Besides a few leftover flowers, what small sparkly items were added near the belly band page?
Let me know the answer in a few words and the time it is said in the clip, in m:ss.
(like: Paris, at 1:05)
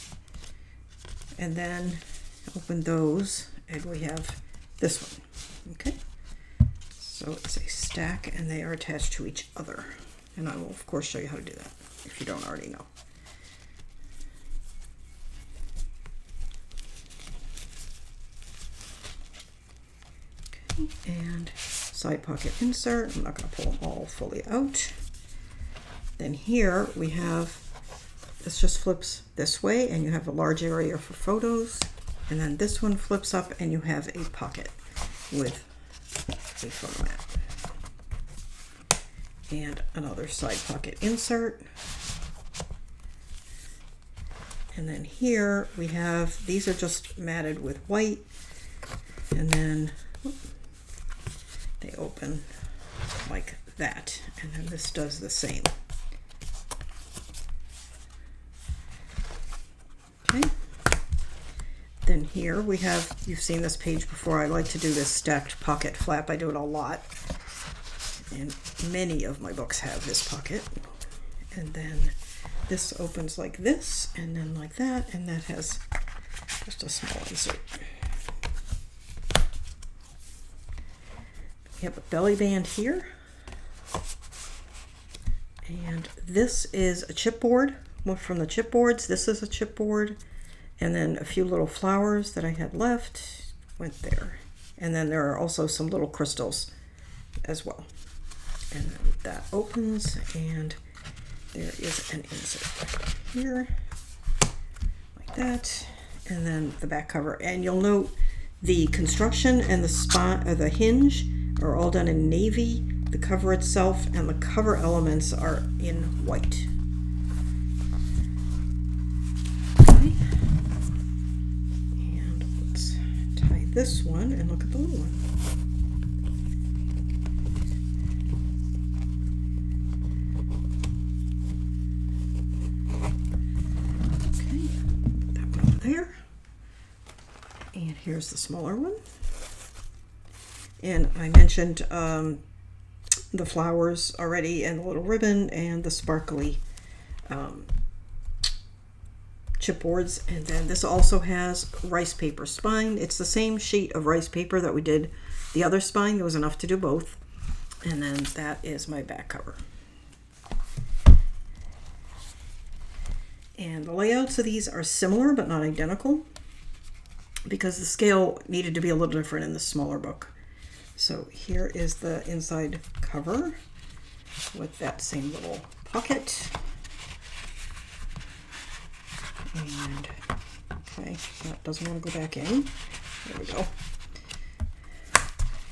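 Crystals, at 1:36.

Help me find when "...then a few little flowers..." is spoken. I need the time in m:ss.
1:30.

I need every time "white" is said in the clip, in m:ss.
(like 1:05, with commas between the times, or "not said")
0:47, 1:56.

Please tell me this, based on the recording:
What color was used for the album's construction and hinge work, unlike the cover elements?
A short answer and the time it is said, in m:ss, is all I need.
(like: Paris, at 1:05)
Navy, at 1:52.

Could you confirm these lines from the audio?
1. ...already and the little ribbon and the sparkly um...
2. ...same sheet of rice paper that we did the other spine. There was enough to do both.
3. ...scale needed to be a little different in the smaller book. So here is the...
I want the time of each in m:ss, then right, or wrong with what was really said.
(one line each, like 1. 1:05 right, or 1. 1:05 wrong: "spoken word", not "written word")
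1. 2:24 right
2. 2:33 right
3. 2:47 right.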